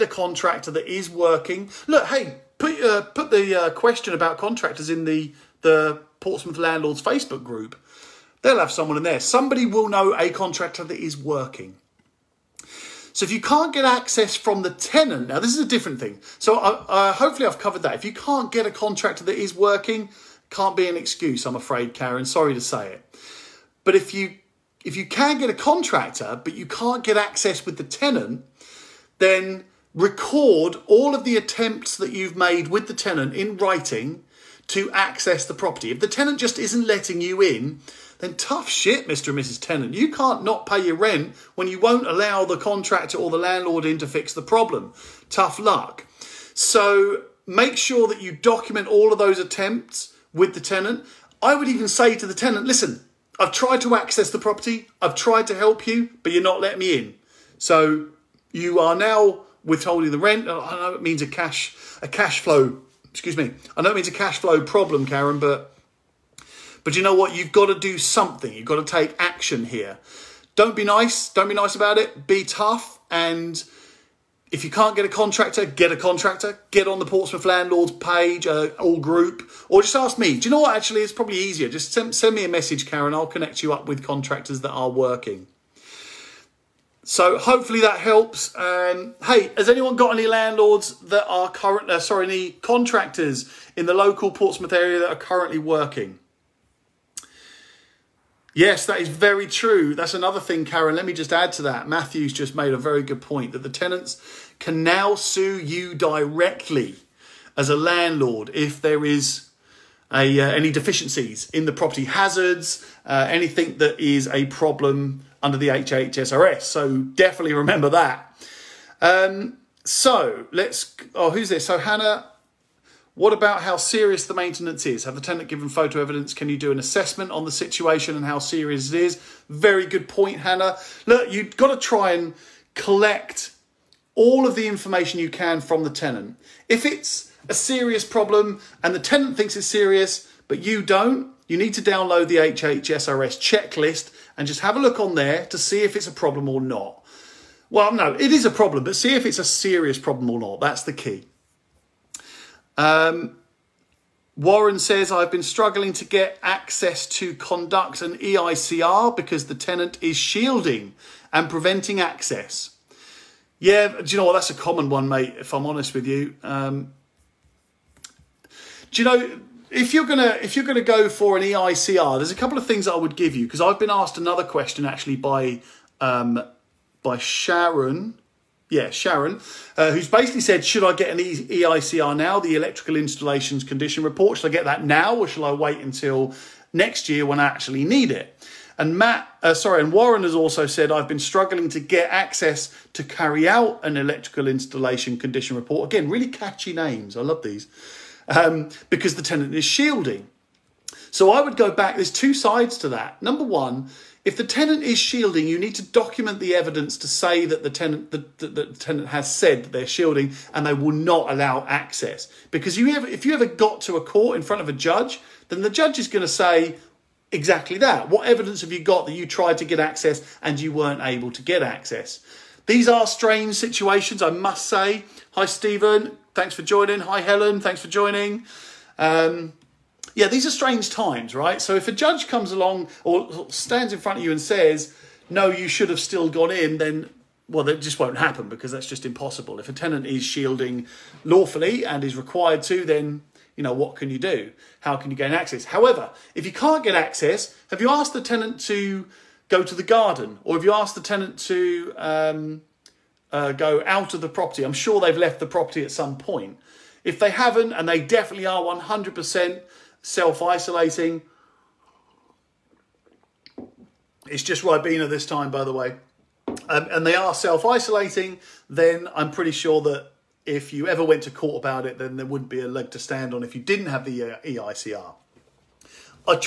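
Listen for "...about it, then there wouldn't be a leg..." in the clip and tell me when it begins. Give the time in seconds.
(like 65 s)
271 s.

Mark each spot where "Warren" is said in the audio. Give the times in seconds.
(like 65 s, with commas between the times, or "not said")
154 s, 189 s.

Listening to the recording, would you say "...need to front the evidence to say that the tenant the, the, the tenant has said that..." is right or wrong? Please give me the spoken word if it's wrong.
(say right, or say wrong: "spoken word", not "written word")
wrong: "document", not "front".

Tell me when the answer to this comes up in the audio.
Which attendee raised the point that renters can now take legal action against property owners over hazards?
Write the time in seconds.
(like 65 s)
101 s.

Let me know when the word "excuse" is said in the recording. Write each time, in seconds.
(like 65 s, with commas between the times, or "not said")
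20 s, 63 s.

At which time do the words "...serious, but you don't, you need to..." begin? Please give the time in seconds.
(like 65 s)
139 s.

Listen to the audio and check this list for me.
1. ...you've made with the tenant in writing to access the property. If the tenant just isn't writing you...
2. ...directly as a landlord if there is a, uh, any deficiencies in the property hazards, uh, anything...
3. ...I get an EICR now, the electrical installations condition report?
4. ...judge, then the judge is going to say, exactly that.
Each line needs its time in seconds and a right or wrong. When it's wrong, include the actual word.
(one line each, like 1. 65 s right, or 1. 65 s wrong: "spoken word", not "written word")
1. 32 s wrong: "letting", not "writing"
2. 105 s right
3. 180 s right
4. 214 s right.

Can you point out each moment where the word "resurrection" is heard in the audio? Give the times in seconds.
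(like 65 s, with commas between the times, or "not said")
not said.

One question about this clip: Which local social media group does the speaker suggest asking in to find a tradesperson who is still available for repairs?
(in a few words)
Portsmouth landlords Facebook group.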